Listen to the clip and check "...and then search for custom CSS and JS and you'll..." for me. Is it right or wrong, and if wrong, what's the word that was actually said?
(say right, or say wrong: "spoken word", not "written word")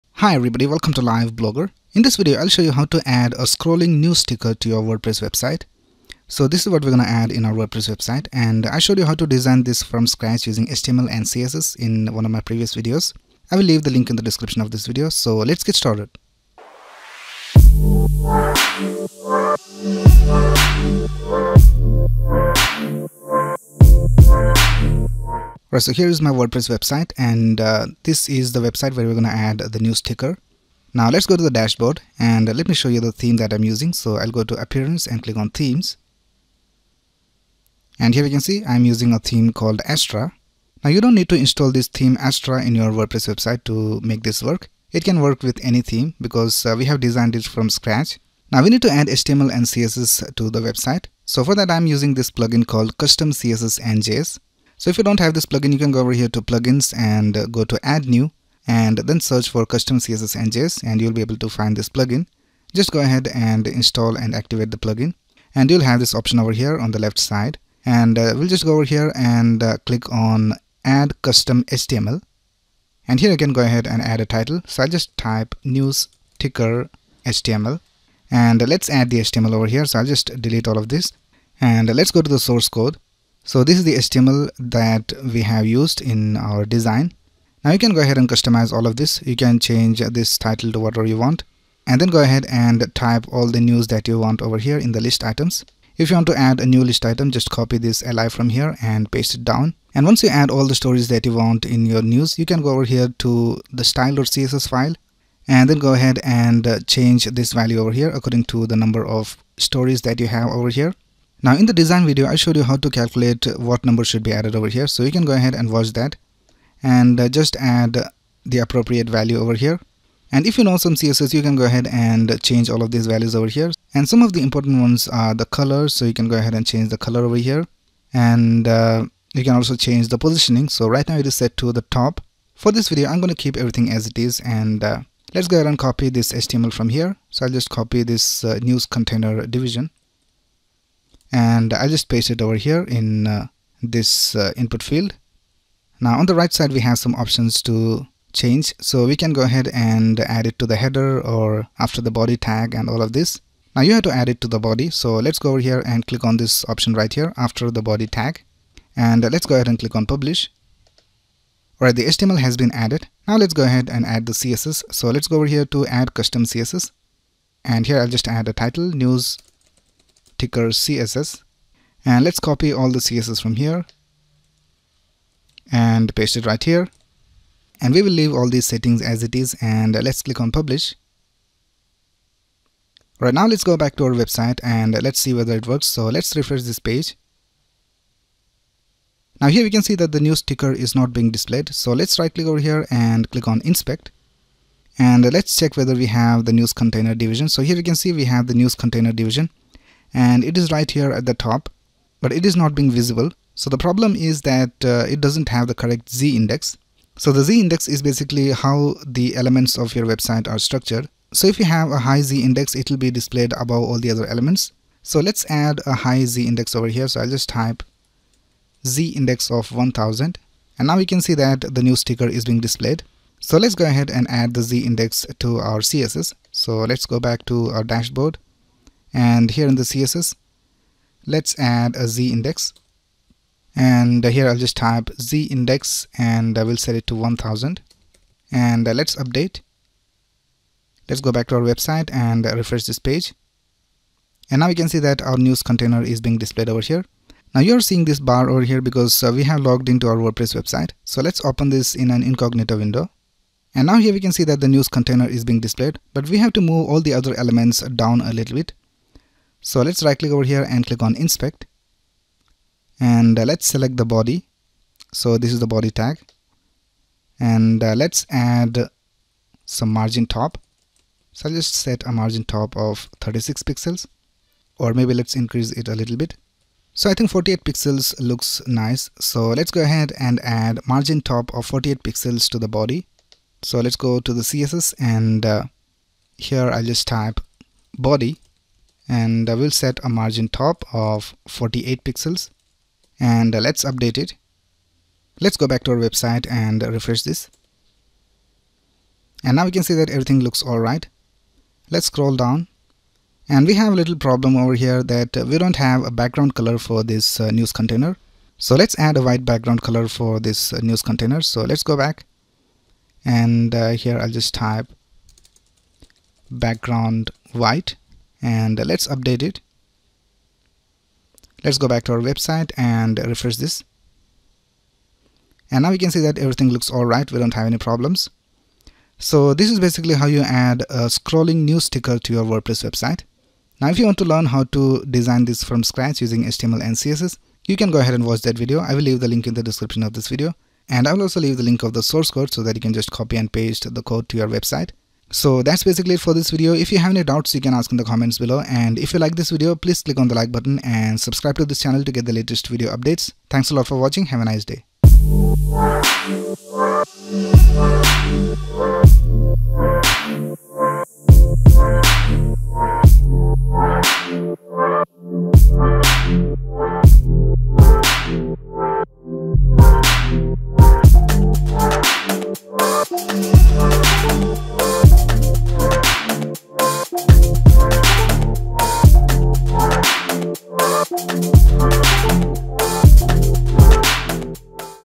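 right.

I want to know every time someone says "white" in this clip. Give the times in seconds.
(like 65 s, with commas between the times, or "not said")
309 s, 317 s.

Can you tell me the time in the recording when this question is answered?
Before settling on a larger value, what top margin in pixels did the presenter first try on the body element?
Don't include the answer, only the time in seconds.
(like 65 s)
273 s.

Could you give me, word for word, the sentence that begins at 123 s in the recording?
And some of the important ones are the color.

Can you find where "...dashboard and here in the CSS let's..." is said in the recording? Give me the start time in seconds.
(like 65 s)
227 s.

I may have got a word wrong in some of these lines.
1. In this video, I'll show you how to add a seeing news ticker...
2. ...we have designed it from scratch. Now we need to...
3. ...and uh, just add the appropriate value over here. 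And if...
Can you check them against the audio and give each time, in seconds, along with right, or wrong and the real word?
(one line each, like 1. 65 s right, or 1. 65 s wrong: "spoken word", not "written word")
1. 1 s wrong: "scrolling", not "seeing"
2. 46 s right
3. 116 s right.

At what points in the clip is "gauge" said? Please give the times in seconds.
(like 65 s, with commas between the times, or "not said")
not said.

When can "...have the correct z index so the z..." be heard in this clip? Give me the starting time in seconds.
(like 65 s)
205 s.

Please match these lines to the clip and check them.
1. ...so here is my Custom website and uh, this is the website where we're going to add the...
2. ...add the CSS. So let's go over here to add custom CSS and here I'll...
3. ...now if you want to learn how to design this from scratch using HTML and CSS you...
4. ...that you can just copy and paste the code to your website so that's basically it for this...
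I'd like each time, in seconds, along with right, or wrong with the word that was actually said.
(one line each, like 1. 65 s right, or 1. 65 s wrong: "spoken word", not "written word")
1. 25 s wrong: "WordPress", not "Custom"
2. 164 s right
3. 333 s right
4. 342 s right.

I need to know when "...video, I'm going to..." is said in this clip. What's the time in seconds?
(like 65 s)
132 s.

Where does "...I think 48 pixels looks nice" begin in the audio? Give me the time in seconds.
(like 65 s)
277 s.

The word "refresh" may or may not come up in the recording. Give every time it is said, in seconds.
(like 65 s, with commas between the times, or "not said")
186 s, 242 s, 296 s, 323 s.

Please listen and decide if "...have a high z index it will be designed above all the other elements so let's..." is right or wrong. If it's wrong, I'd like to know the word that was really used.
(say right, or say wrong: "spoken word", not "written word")
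wrong: "displayed", not "designed".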